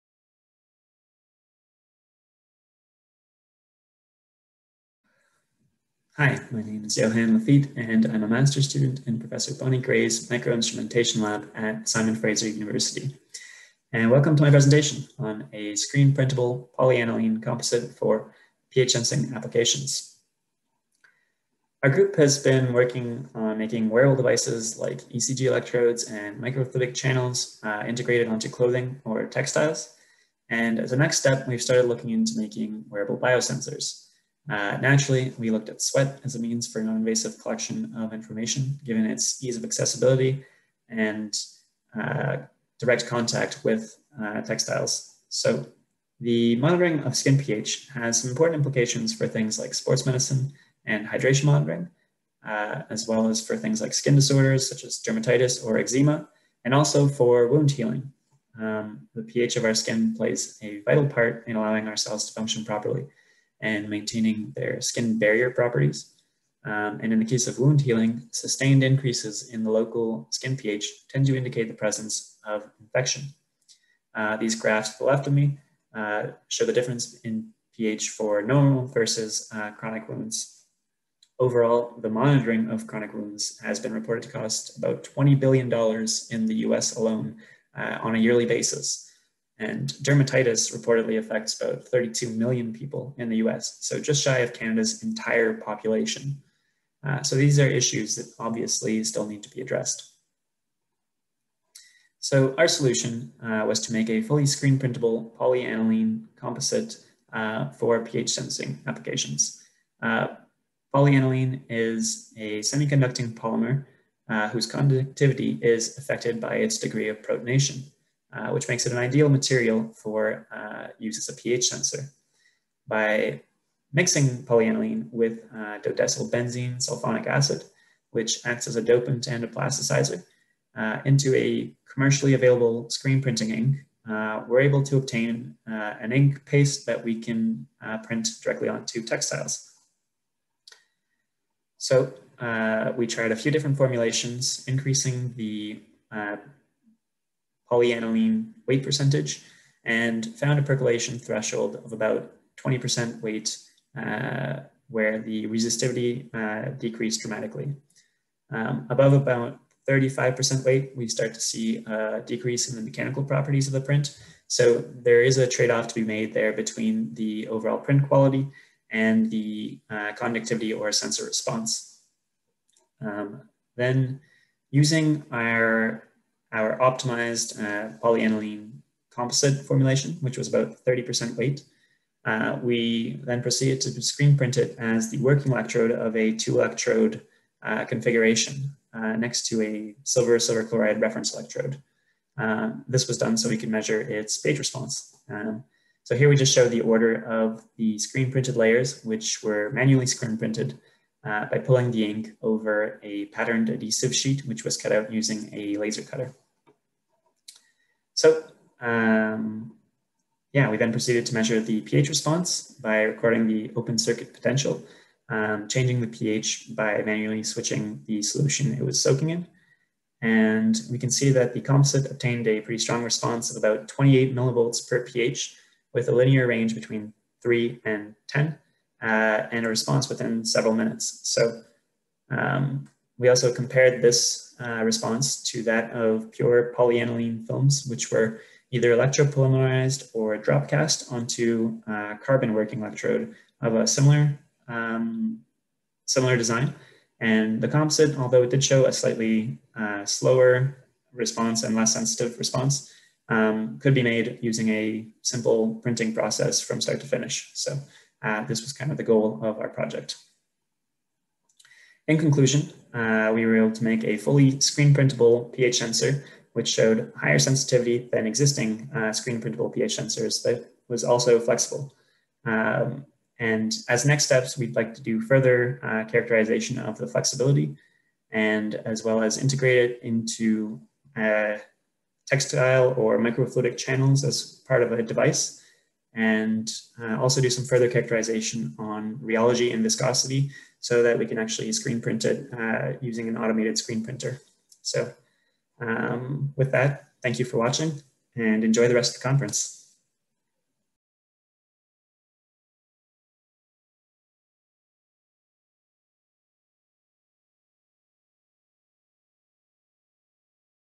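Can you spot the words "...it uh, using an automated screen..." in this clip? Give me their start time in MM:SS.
04:52.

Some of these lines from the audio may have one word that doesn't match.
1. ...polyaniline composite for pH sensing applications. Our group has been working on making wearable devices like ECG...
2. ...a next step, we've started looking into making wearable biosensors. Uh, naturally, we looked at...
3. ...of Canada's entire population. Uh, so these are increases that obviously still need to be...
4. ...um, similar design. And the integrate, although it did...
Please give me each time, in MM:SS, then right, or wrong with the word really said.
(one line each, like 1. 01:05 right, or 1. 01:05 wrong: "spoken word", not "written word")
1. 00:16 right
2. 00:30 right
3. 01:34 wrong: "issues", not "increases"
4. 04:04 wrong: "composite", not "integrate".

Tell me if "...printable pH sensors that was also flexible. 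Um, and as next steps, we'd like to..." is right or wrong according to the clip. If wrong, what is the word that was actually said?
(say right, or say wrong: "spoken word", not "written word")
right.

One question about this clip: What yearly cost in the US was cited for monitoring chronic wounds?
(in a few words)
$20 billion.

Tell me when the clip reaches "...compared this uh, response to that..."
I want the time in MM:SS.
03:53.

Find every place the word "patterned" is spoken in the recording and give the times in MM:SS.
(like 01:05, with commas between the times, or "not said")
03:23.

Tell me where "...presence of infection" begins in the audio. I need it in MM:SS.
01:11.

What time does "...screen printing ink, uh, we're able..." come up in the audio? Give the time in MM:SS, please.
02:12.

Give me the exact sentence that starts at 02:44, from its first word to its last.
So there is a trade-off to be made there between the overall print quality and the uh, conductivity or sensor response.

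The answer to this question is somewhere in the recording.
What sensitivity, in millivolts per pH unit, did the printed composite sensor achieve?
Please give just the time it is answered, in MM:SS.
03:43.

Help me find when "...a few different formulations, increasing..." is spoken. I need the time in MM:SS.
02:23.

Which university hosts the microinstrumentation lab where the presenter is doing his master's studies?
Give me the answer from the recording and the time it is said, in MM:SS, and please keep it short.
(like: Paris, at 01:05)
Simon Fraser University, at 00:11.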